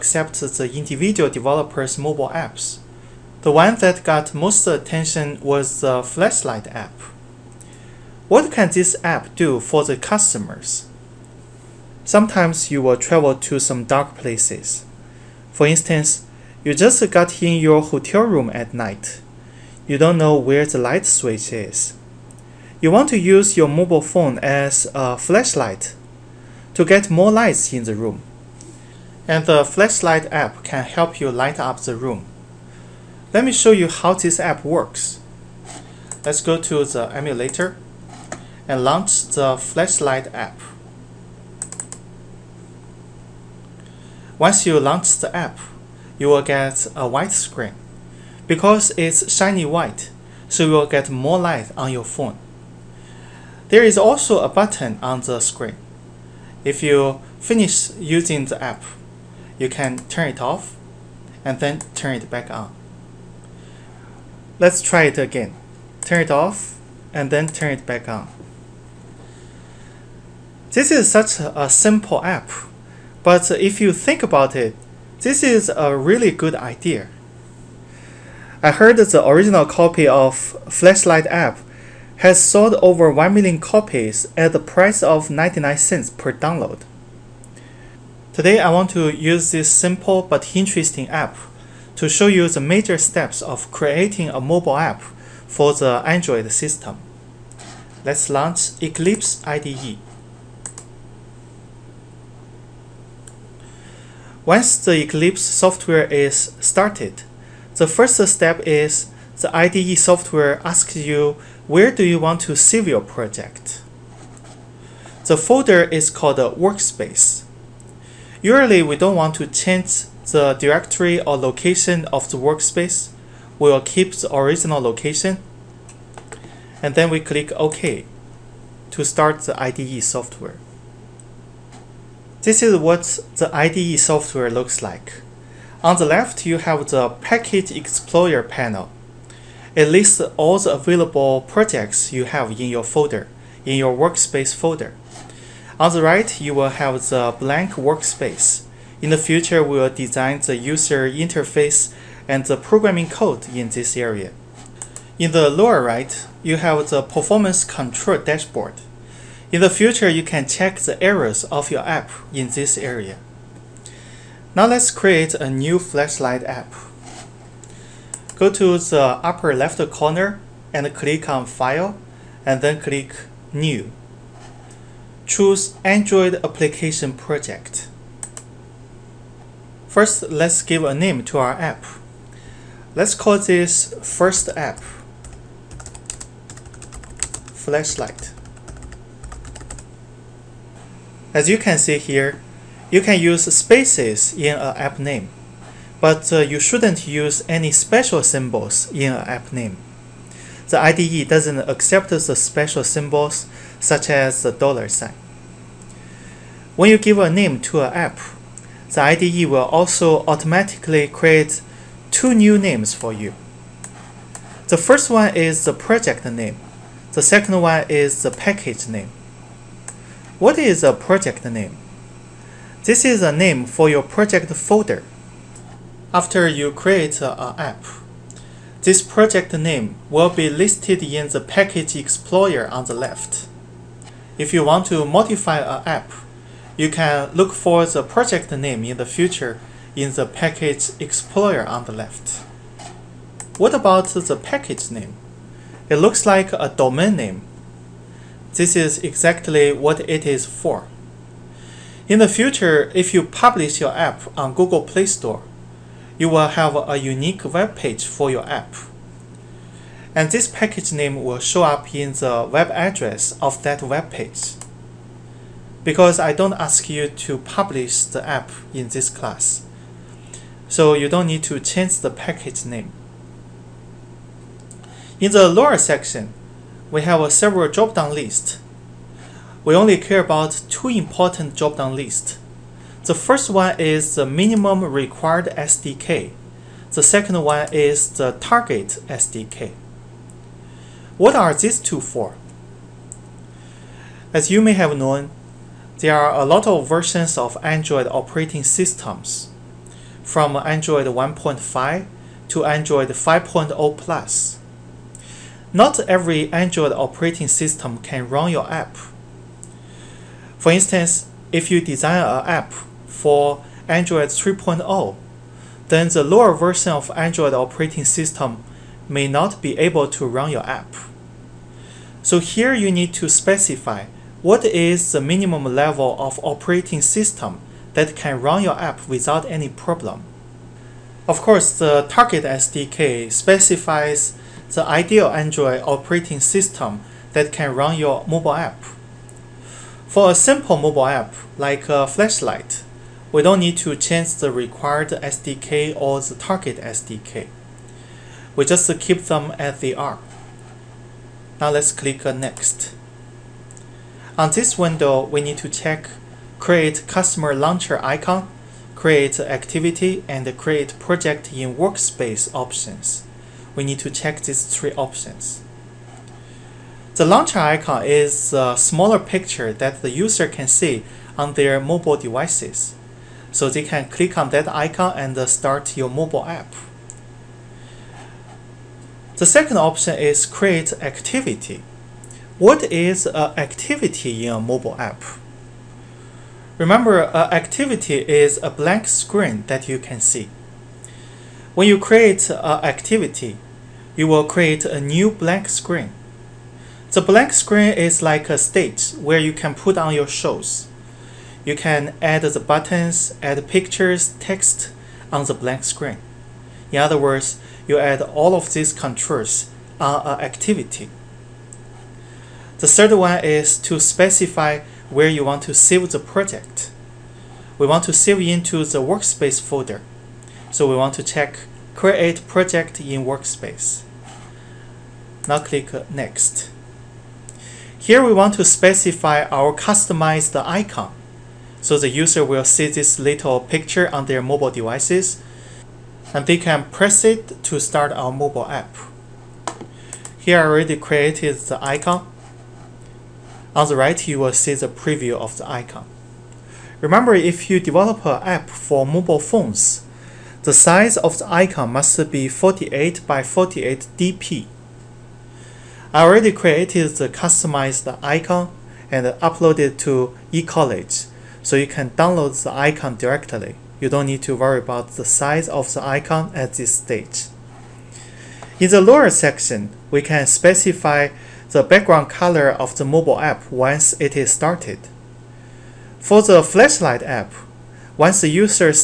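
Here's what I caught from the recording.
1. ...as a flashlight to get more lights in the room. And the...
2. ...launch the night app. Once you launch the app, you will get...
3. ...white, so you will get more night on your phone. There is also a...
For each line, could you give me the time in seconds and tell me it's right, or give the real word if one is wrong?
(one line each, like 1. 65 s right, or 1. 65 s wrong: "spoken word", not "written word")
1. 24 s right
2. 38 s wrong: "flashlight", not "night"
3. 49 s wrong: "light", not "night".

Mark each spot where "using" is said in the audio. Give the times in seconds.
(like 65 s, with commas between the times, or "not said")
57 s.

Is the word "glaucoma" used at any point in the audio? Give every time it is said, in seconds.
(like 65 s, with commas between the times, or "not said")
not said.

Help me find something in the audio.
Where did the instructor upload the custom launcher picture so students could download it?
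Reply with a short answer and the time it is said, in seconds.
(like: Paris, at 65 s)
eCollege, at 460 s.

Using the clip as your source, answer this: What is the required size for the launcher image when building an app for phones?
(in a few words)
48 by 48 dp.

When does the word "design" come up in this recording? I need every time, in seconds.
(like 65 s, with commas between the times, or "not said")
149 s, 311 s.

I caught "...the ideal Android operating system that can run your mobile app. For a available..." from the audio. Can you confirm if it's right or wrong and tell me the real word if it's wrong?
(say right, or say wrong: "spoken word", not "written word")
wrong: "simple", not "available".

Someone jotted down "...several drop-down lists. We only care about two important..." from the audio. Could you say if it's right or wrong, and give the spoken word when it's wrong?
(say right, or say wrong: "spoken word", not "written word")
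right.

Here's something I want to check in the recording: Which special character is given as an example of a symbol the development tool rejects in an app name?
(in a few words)
dollar sign.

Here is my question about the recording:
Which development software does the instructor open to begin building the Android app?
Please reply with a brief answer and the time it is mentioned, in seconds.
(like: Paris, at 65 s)
Eclipse IDE, at 98 s.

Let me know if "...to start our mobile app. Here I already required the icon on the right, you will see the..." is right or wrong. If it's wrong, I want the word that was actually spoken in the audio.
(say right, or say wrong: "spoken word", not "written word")
wrong: "created", not "required".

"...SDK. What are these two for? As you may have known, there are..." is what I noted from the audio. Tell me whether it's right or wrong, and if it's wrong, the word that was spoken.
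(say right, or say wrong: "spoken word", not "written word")
right.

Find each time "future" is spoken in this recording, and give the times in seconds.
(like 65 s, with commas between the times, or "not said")
149 s, 159 s, 239 s, 252 s.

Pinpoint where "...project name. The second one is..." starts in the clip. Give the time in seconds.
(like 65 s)
215 s.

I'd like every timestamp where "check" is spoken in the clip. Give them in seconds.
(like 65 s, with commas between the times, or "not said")
160 s, 355 s, 364 s, 421 s.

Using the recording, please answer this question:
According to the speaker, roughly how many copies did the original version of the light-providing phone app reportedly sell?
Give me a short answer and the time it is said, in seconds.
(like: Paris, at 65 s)
over 1 million, at 82 s.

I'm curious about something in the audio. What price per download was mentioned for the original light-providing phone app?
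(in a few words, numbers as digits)
99 cents.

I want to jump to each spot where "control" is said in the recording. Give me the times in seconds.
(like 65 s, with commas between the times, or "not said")
157 s, 408 s.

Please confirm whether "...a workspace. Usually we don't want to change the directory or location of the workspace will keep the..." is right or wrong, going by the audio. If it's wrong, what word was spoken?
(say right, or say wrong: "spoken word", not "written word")
right.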